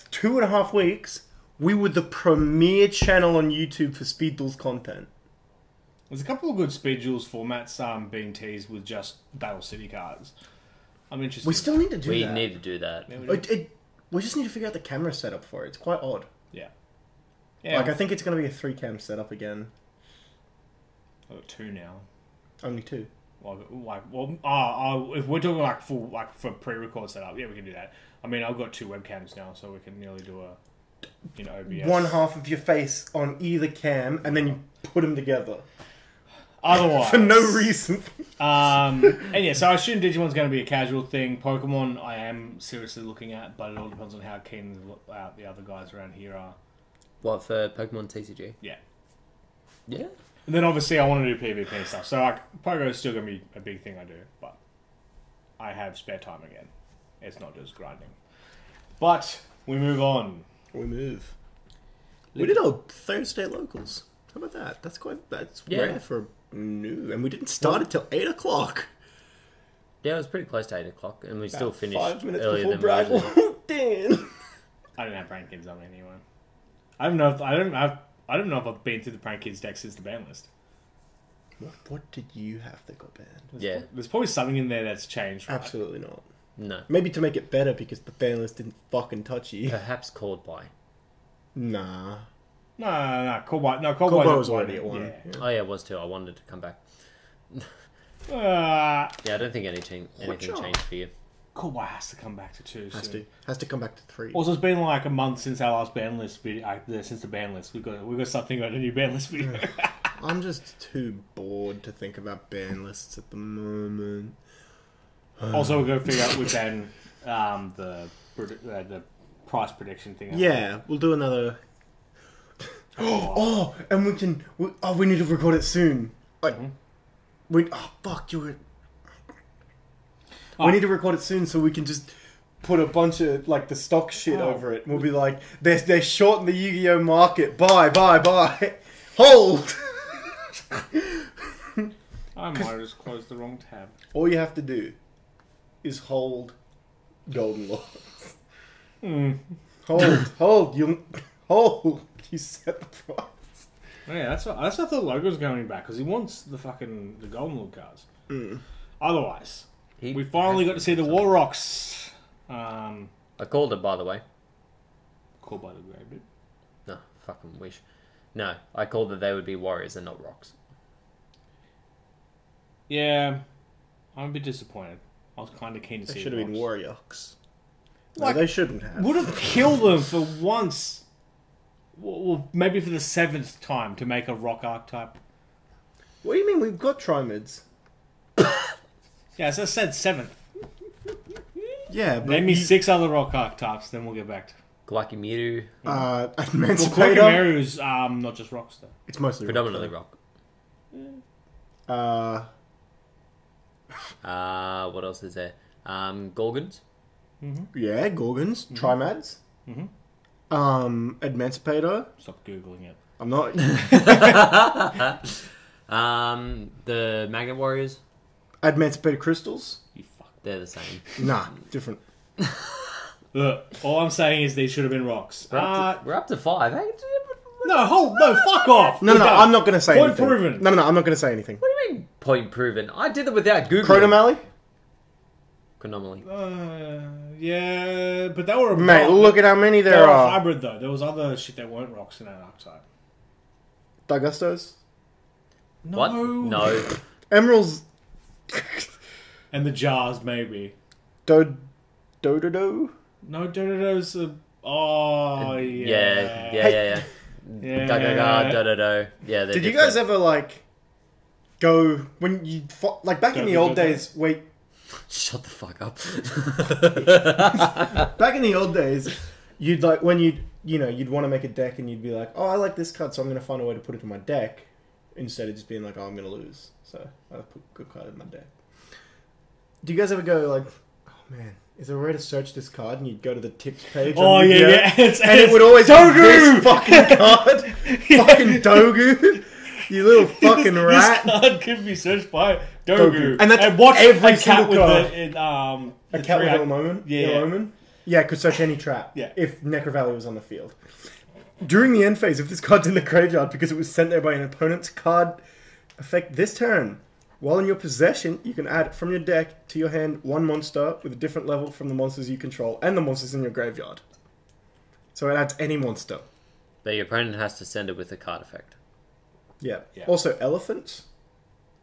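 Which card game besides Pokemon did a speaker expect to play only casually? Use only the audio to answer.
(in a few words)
Digimon.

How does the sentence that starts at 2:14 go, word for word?
We'll be like, they're they're shorting the Yu-Gi-Oh market.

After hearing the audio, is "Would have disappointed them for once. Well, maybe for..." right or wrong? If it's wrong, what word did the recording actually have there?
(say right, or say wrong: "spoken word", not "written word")
wrong: "killed", not "disappointed".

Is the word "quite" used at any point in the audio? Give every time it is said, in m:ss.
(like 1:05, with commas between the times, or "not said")
0:15, 1:04.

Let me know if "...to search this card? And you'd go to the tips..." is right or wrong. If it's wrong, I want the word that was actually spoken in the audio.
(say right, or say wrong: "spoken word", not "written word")
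right.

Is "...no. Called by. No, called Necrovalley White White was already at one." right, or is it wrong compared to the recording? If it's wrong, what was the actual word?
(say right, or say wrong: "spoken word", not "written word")
wrong: "Cold", not "Necrovalley".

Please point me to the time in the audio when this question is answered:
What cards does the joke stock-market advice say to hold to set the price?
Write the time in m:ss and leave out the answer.
2:27.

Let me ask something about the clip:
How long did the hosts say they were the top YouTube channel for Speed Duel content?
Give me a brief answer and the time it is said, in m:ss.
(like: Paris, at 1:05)
two and a half weeks, at 0:00.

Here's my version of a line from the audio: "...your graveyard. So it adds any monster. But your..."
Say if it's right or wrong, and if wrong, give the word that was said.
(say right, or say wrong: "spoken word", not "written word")
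right.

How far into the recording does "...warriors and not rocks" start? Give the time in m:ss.
2:49.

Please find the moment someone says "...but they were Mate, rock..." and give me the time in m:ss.
3:58.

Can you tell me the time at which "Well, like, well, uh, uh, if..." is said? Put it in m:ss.
0:23.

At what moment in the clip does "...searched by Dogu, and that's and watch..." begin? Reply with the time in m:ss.
4:51.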